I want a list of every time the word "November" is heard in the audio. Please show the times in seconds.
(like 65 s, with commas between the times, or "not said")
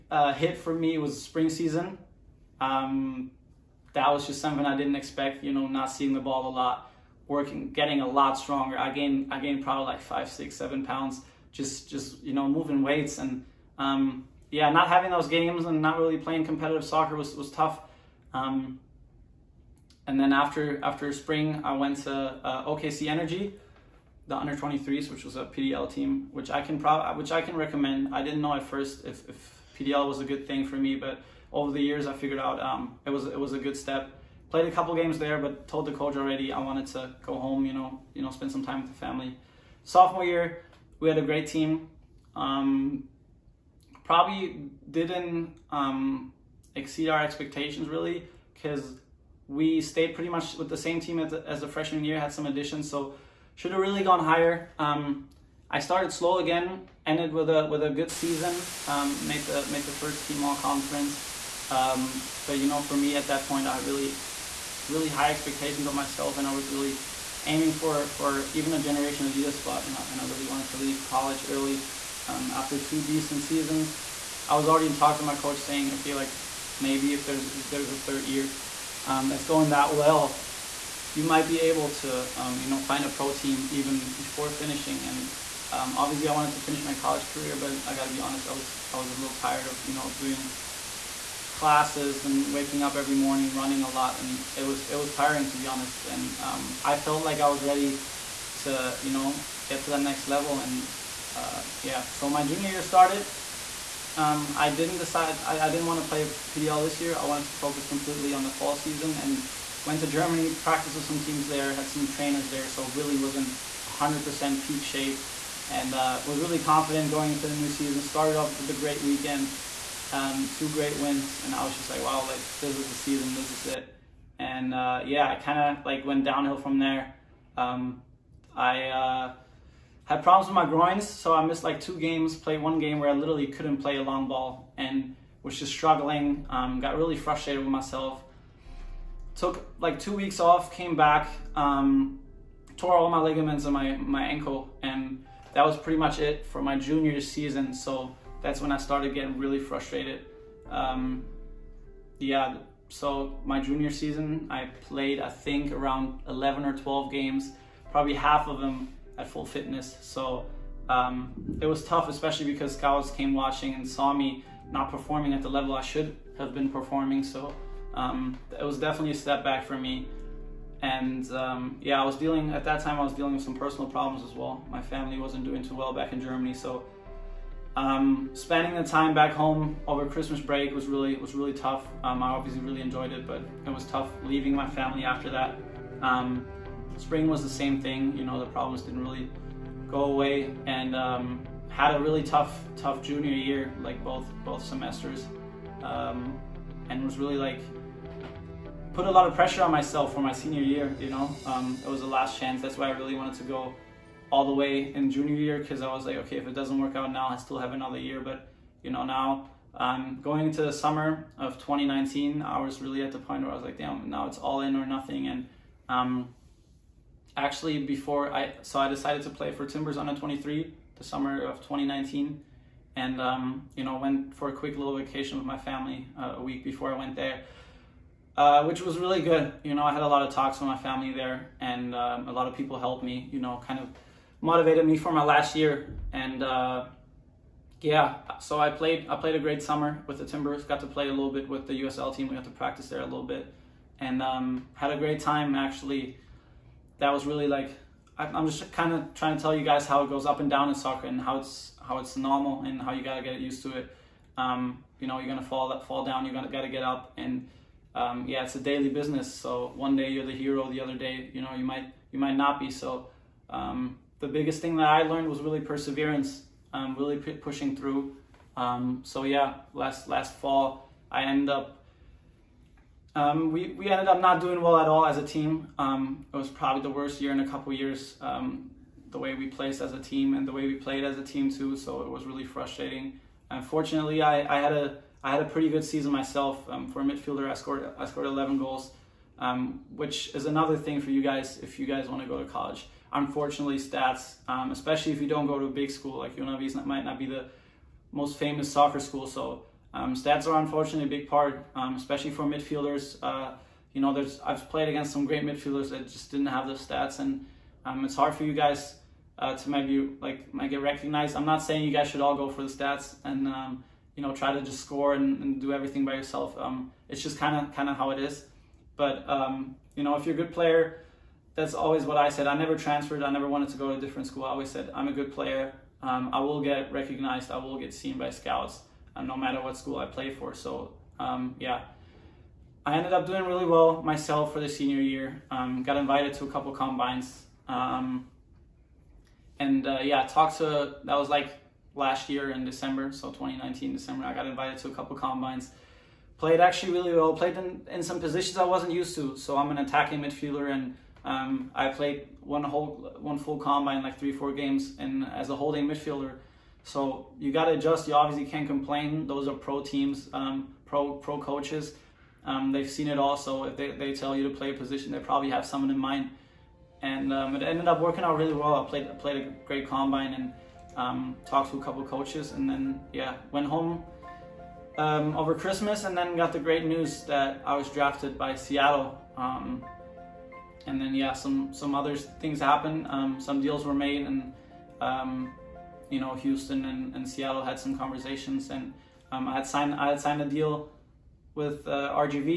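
not said.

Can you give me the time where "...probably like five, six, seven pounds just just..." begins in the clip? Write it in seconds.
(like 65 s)
9 s.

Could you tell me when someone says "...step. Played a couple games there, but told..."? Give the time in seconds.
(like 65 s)
33 s.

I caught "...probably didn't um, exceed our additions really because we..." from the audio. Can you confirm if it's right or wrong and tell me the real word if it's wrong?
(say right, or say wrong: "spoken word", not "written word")
wrong: "expectations", not "additions".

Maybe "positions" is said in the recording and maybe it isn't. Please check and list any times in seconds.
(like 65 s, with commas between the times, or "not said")
348 s, 364 s.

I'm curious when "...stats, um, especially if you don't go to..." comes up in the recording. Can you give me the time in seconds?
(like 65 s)
293 s.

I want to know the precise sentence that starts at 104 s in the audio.
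Um, I didn't decide I, I didn't want to play PDL this year.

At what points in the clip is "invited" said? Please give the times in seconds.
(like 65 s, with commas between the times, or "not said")
335 s, 344 s.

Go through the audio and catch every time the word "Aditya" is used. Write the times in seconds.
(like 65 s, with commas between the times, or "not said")
not said.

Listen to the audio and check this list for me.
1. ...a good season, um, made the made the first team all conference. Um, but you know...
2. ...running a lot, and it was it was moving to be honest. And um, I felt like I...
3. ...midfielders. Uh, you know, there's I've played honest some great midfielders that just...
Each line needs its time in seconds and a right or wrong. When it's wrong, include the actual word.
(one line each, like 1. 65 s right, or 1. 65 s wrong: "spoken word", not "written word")
1. 57 s right
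2. 93 s wrong: "tiring", not "moving"
3. 302 s wrong: "against", not "honest".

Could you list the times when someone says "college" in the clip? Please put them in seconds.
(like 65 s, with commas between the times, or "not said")
71 s, 86 s, 292 s.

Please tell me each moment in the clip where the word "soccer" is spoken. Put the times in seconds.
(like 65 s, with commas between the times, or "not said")
16 s, 250 s, 298 s.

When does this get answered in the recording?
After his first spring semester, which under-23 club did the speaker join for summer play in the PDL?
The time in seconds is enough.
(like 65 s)
22 s.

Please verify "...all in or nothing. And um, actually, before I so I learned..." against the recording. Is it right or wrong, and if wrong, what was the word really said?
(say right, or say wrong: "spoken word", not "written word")
wrong: "decided", not "learned".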